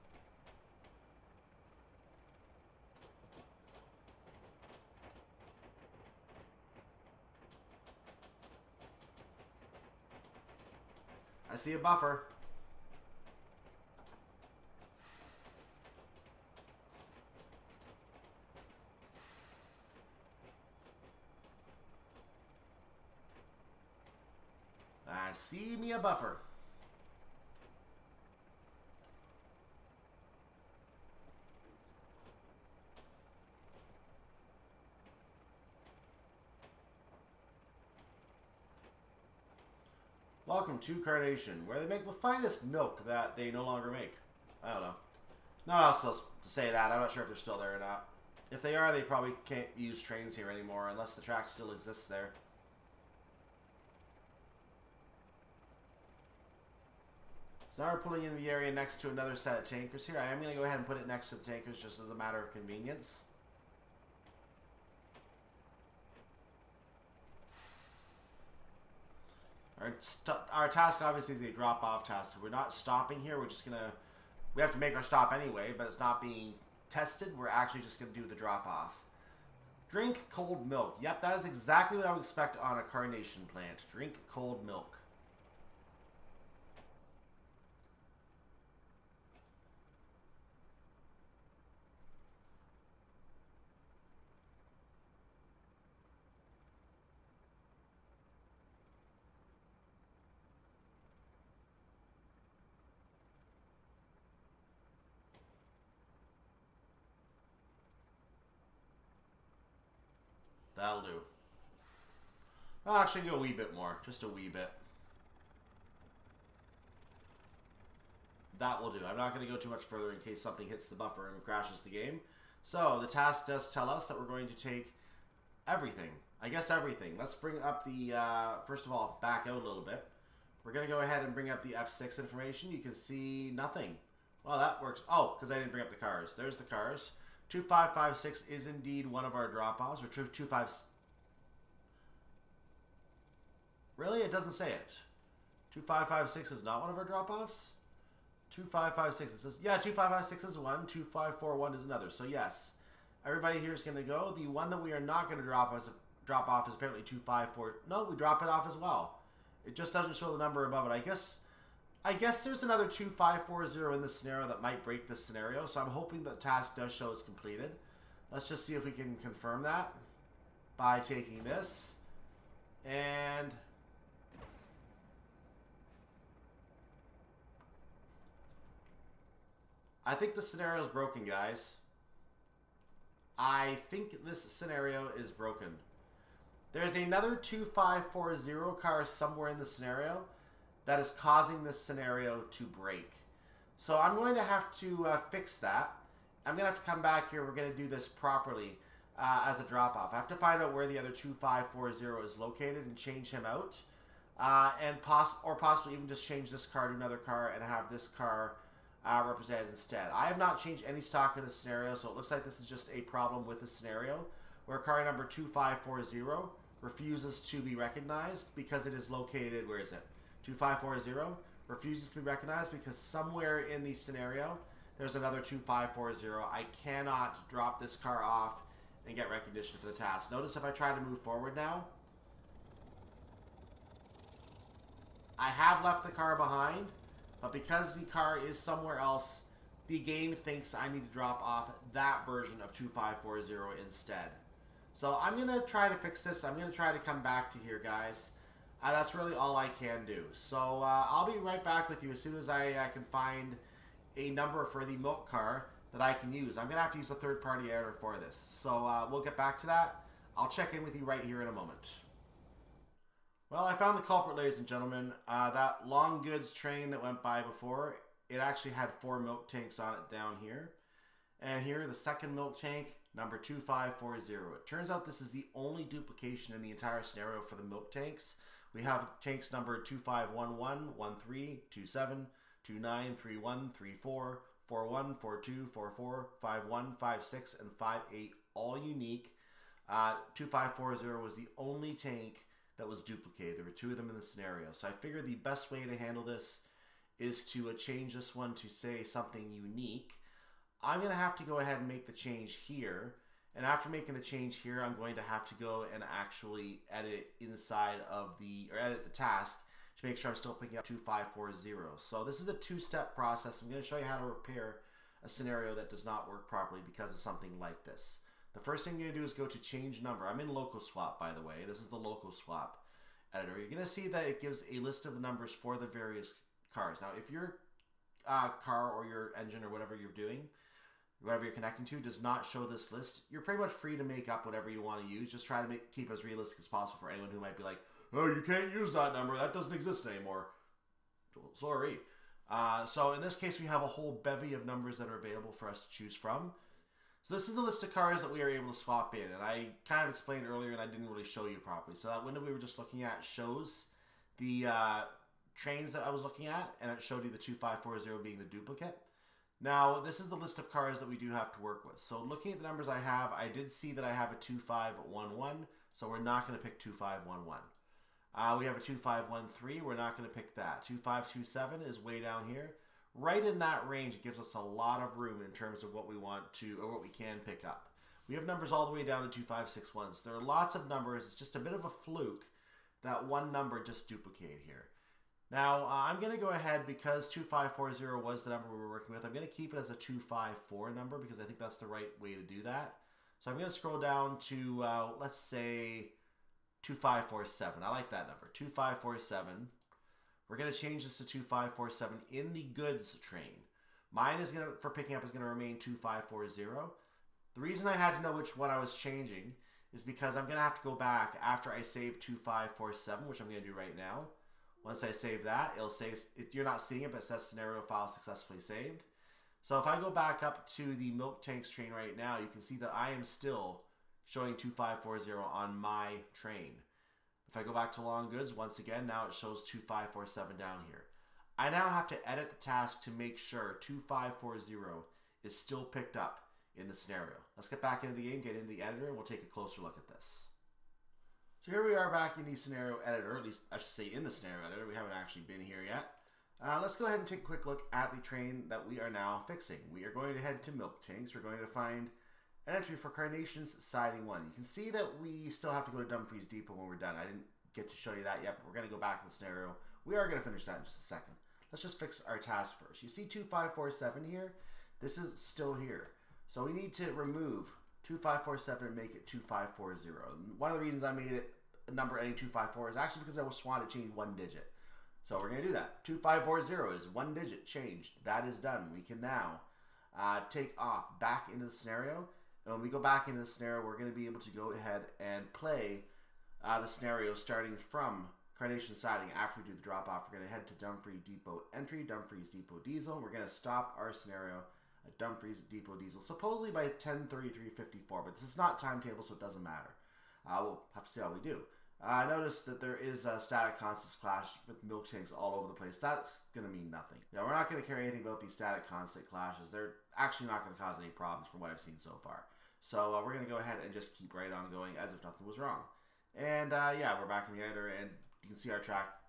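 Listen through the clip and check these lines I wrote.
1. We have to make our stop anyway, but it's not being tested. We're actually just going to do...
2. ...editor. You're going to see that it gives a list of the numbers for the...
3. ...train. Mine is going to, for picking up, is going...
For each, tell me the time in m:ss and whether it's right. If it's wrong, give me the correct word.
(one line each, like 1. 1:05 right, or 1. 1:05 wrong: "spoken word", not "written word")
1. 1:14 right
2. 5:23 right
3. 6:43 right.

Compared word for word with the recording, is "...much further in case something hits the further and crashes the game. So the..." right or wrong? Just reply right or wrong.
wrong.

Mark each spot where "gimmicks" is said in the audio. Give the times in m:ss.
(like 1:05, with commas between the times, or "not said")
not said.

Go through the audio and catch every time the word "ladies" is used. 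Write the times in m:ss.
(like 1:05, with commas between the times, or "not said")
4:24.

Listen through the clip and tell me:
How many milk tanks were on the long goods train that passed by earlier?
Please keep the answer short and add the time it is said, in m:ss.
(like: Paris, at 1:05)
four, at 4:29.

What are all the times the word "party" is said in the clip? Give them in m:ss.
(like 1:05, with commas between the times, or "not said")
4:17.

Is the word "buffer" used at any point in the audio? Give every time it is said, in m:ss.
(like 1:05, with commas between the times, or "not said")
0:11, 0:25, 2:00.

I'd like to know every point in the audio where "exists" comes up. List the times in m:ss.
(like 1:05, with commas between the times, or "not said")
0:51, 5:39.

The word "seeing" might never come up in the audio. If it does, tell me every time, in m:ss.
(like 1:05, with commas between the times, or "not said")
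6:56.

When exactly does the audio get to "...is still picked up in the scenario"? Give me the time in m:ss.
7:15.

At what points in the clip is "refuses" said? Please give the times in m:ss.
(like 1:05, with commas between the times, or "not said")
3:36, 3:41.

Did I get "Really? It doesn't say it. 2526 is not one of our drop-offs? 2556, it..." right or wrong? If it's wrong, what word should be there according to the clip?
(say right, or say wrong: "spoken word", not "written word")
wrong: "2556", not "2526".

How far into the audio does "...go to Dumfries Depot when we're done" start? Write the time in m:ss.
7:35.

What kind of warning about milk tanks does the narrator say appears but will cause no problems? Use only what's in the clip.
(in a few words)
static consist clash.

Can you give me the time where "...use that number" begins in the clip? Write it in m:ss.
5:38.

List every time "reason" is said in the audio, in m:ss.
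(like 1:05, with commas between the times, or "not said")
6:47, 7:50.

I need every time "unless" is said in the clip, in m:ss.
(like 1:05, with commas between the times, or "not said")
0:50.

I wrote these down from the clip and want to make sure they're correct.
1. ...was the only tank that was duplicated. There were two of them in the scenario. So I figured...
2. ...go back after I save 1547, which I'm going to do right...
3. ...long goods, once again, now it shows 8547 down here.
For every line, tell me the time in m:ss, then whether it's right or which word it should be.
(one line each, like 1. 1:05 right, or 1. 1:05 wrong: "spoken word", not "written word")
1. 4:51 right
2. 6:50 wrong: "2547", not "1547"
3. 7:08 wrong: "2547", not "8547".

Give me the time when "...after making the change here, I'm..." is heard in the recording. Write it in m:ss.
5:03.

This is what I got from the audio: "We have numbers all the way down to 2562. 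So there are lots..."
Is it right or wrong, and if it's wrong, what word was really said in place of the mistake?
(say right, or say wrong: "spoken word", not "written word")
wrong: "2561", not "2562".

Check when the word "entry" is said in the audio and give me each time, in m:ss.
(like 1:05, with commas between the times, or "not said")
7:32, 8:11.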